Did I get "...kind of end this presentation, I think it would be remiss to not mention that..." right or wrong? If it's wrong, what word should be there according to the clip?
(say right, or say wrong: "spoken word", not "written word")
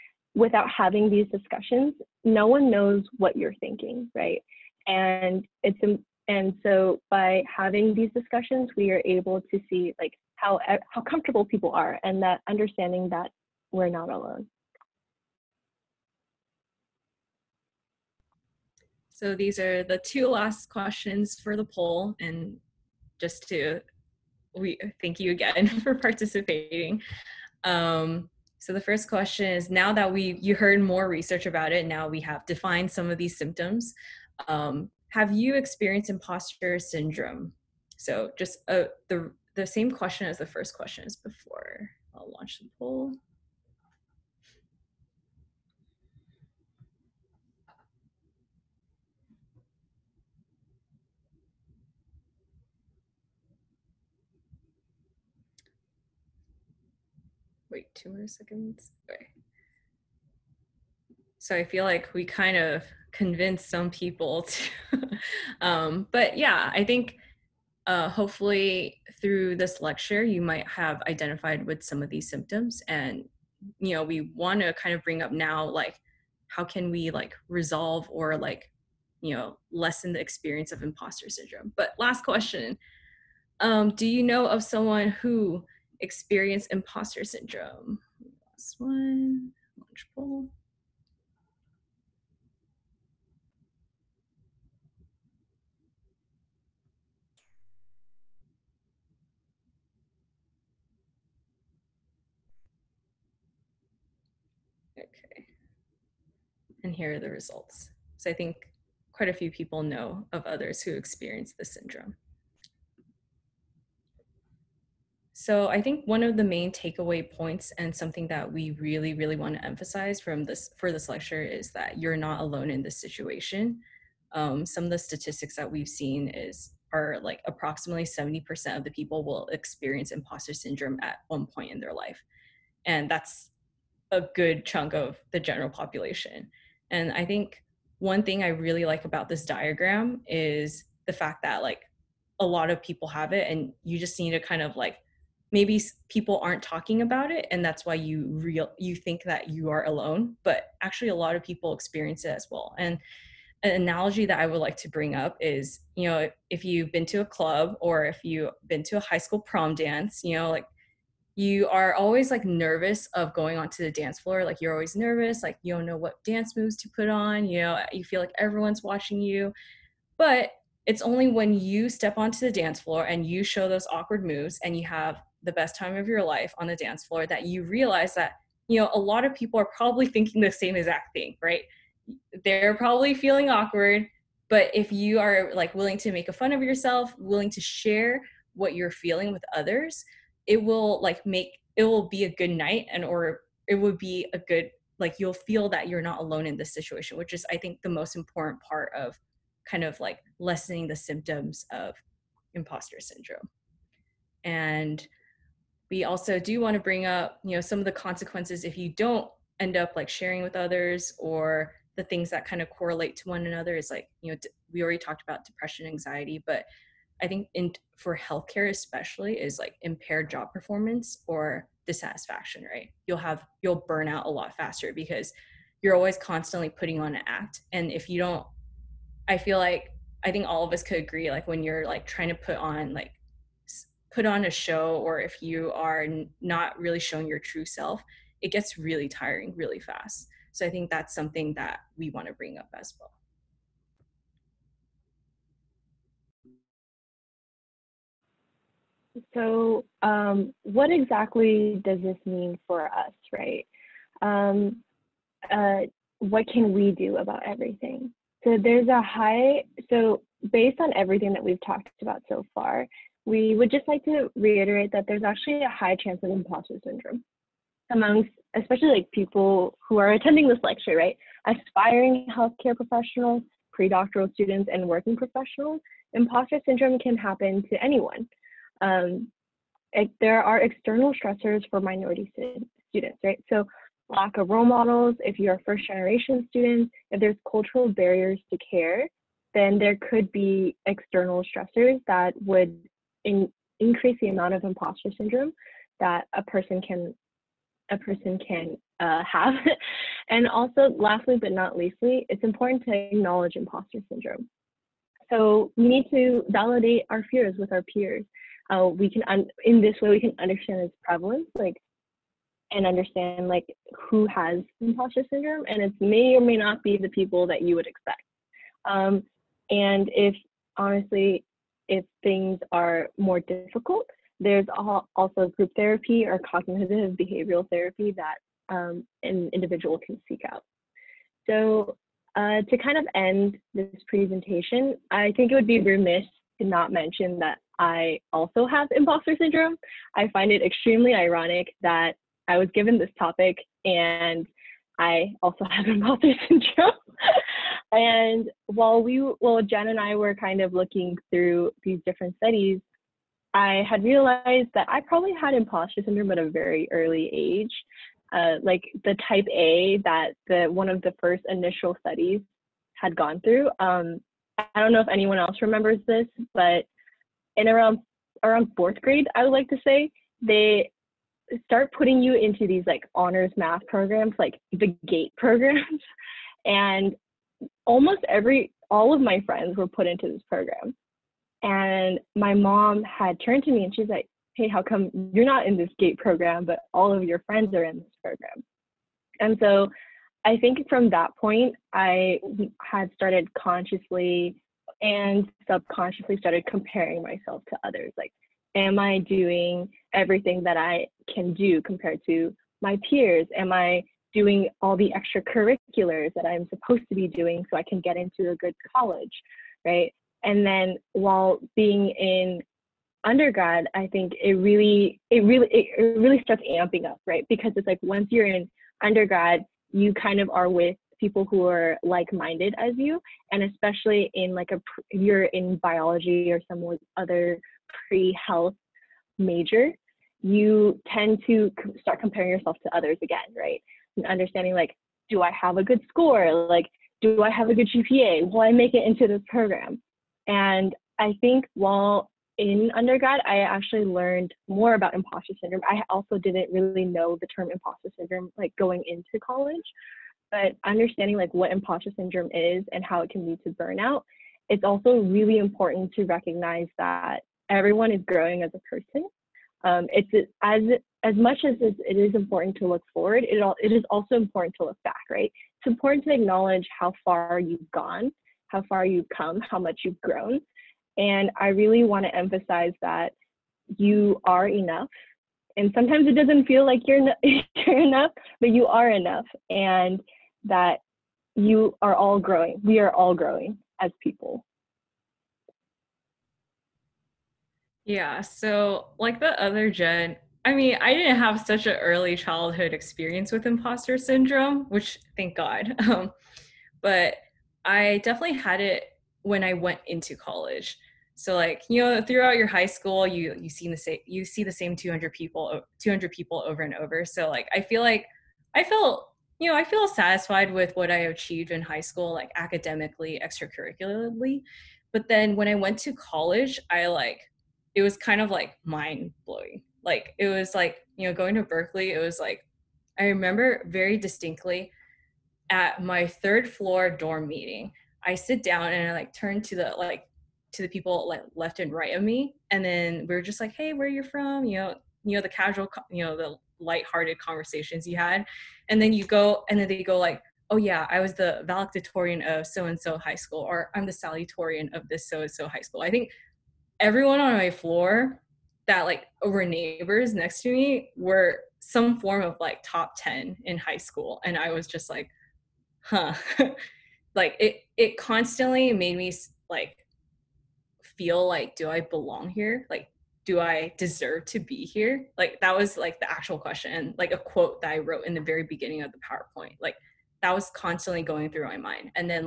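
right.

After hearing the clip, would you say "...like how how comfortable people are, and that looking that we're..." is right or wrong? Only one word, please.
wrong.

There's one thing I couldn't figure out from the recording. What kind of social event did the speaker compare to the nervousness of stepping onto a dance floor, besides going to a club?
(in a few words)
high school prom.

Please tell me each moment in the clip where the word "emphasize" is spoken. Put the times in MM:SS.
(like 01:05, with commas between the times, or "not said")
01:59, 07:52.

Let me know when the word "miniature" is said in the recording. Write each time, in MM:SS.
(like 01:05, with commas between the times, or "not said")
not said.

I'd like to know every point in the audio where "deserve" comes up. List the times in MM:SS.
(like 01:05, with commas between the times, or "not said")
09:23.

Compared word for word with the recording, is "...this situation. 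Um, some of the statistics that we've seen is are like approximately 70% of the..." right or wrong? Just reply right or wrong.
right.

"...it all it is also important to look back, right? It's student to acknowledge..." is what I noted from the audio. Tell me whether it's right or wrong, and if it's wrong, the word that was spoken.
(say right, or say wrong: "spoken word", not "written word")
wrong: "important", not "student".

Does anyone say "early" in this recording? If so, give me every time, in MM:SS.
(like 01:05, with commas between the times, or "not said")
05:56, 08:11.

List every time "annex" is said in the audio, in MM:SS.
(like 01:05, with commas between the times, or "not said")
not said.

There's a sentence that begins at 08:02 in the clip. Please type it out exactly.
We are all growing as people.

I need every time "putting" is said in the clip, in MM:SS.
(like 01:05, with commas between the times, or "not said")
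03:46, 06:11.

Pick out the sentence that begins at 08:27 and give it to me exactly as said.
So like I feel like I felt you know I feel satisfied with what I achieved in high school, like academically, extracurricularly.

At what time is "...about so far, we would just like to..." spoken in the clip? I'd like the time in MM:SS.
04:22.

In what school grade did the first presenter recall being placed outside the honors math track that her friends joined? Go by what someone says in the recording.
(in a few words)
fourth grade.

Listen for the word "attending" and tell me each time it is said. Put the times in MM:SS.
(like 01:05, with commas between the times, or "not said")
04:30.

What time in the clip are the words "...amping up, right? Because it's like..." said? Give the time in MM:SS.
06:56.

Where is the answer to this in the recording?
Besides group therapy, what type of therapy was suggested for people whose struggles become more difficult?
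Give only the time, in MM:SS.
05:26.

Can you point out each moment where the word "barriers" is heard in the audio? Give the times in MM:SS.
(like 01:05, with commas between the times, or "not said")
04:47.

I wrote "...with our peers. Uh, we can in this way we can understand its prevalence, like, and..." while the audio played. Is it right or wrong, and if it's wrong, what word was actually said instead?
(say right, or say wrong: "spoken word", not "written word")
right.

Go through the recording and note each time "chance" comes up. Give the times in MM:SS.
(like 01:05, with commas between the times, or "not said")
04:26.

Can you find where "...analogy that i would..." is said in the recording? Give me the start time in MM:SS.
02:33.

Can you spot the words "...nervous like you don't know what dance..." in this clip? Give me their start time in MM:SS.
02:44.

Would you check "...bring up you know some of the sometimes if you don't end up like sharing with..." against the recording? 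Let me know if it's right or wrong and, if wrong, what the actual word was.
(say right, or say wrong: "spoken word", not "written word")
wrong: "consequences", not "sometimes".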